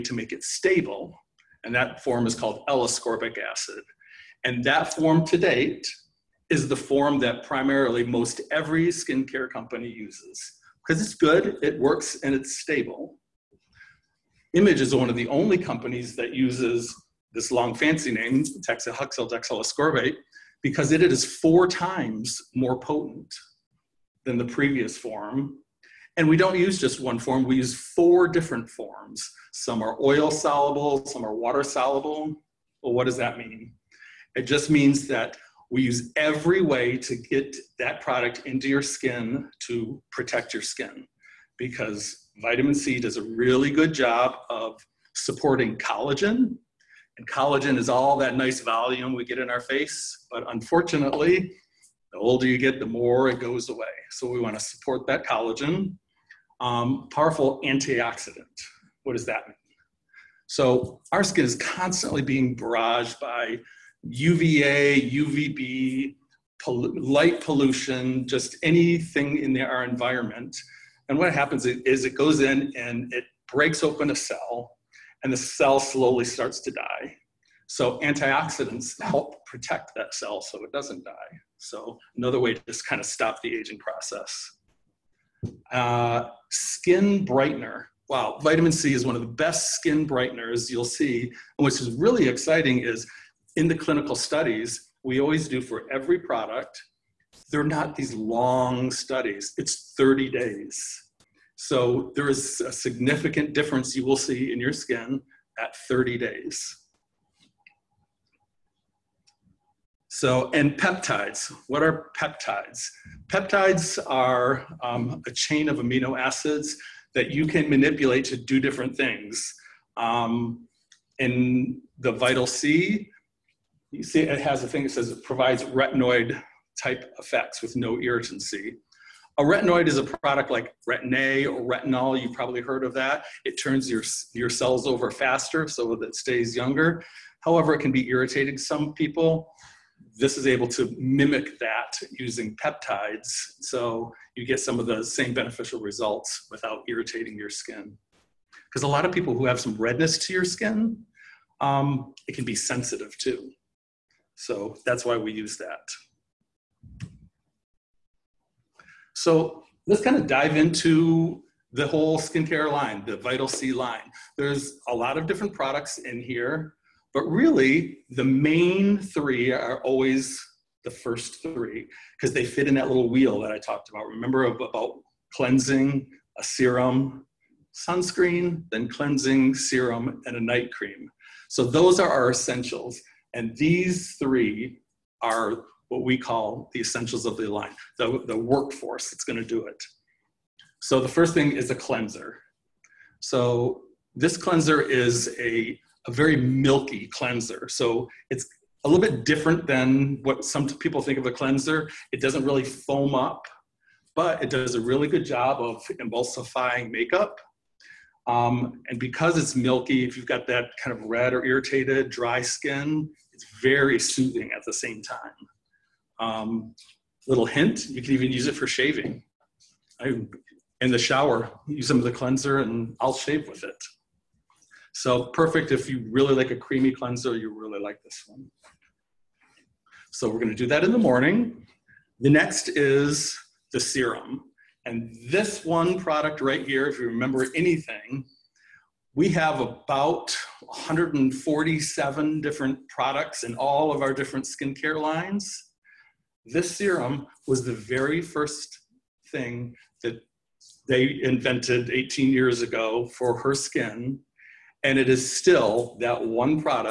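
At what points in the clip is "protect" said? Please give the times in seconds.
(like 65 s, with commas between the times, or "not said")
40 s, 79 s.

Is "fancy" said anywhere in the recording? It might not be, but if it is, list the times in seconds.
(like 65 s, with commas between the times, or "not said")
17 s.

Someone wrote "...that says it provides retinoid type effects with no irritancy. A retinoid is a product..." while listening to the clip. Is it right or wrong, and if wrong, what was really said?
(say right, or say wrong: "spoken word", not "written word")
right.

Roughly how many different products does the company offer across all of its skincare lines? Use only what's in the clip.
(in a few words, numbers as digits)
147.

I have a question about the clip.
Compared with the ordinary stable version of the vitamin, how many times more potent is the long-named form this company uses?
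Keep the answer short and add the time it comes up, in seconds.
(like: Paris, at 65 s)
4, at 21 s.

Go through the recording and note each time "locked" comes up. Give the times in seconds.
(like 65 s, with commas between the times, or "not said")
not said.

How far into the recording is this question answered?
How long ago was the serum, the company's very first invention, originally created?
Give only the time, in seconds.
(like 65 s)
251 s.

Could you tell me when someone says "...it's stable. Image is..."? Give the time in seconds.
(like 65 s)
12 s.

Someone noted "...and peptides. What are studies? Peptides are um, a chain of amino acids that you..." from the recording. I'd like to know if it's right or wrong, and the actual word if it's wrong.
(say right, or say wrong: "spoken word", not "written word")
wrong: "peptides", not "studies".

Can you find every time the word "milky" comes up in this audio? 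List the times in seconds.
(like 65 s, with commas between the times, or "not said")
196 s, 209 s.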